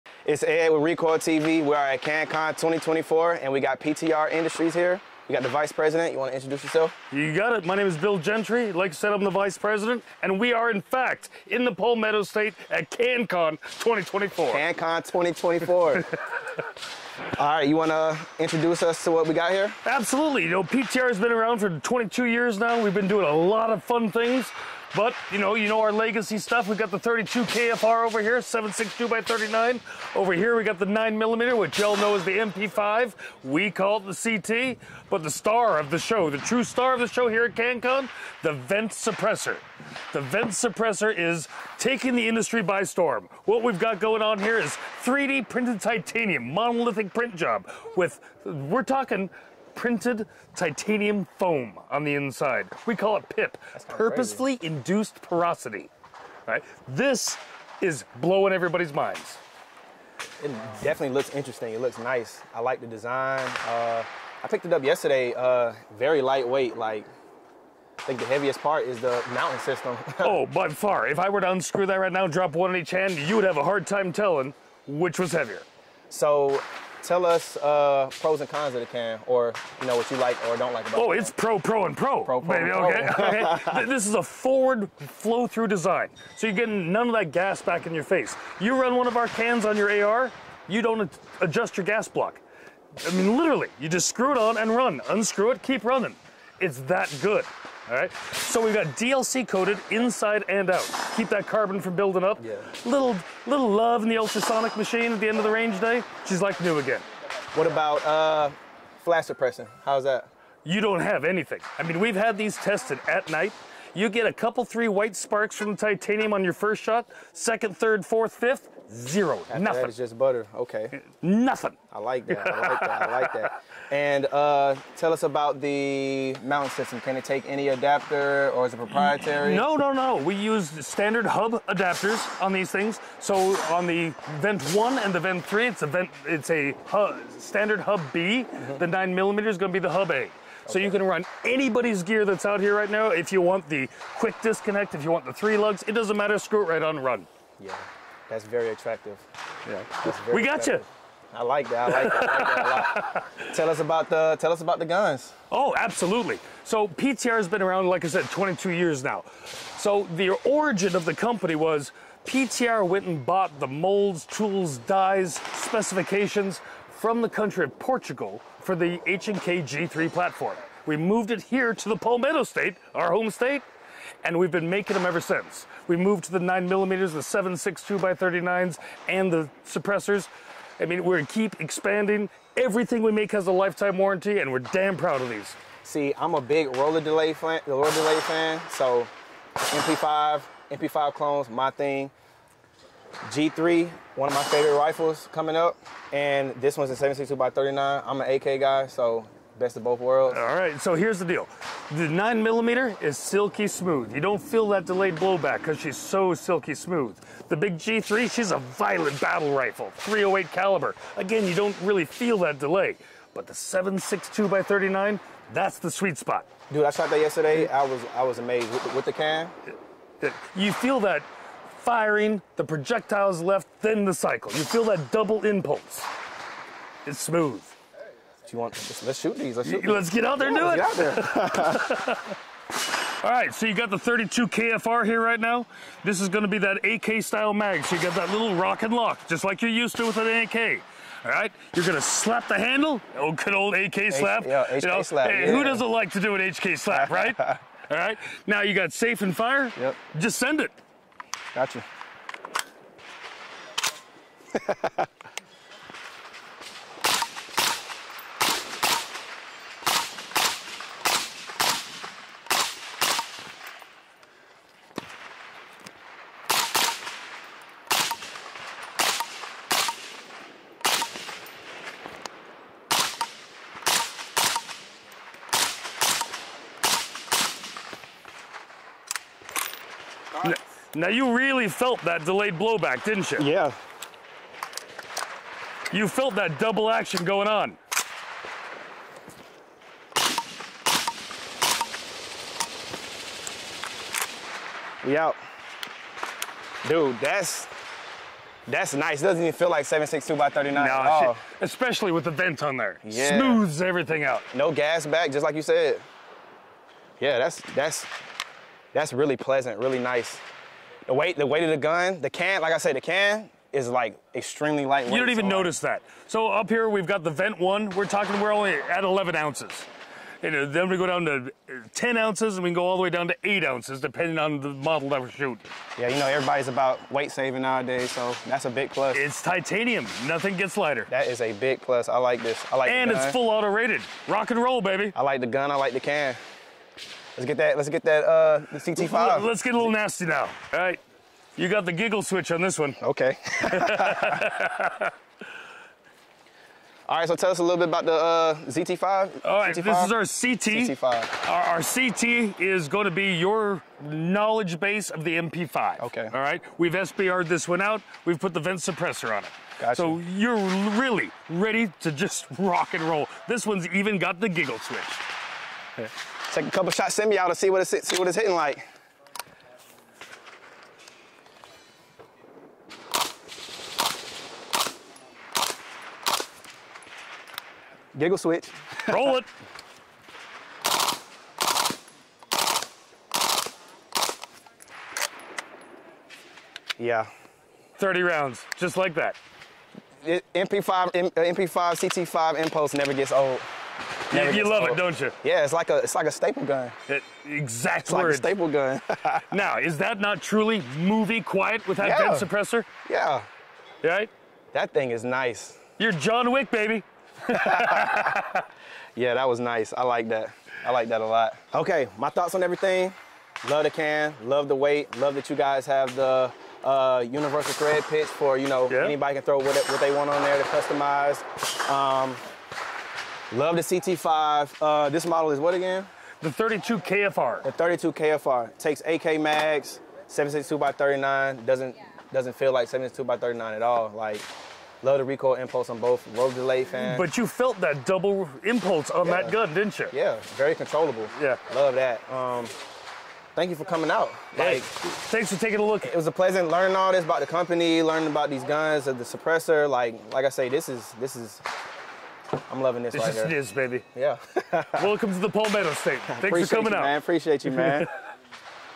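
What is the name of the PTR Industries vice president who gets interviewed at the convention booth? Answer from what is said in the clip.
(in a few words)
Bill Gentry.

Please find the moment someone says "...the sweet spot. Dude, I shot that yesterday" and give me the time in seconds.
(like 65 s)
215 s.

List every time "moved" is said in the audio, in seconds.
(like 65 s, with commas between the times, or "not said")
170 s, 175 s.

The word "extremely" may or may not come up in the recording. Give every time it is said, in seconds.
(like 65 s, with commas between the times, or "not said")
314 s.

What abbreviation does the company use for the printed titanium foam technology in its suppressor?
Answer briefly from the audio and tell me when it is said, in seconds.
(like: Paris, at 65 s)
PIP, at 53 s.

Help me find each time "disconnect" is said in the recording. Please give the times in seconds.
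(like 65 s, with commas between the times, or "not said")
144 s.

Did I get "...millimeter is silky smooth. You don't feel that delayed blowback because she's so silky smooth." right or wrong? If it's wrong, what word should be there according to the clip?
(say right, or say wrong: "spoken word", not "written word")
right.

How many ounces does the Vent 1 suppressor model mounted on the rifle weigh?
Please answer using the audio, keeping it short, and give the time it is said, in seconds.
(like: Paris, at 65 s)
11 ounces, at 319 s.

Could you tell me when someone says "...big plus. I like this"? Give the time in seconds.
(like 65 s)
331 s.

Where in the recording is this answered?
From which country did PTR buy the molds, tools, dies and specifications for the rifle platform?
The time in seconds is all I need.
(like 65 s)
167 s.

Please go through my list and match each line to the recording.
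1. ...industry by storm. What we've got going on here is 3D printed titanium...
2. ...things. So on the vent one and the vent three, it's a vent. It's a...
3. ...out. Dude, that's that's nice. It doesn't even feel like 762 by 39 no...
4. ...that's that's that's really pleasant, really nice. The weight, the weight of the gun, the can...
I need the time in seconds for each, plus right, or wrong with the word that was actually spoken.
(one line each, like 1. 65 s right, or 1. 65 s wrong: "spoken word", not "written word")
1. 42 s right
2. 132 s right
3. 295 s right
4. 307 s right.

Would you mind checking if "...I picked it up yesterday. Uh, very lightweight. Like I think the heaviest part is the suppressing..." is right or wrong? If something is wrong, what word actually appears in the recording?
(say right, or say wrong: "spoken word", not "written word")
wrong: "mounting", not "suppressing".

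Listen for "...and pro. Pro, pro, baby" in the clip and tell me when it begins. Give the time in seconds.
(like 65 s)
81 s.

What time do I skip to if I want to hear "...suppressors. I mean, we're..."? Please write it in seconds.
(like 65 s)
179 s.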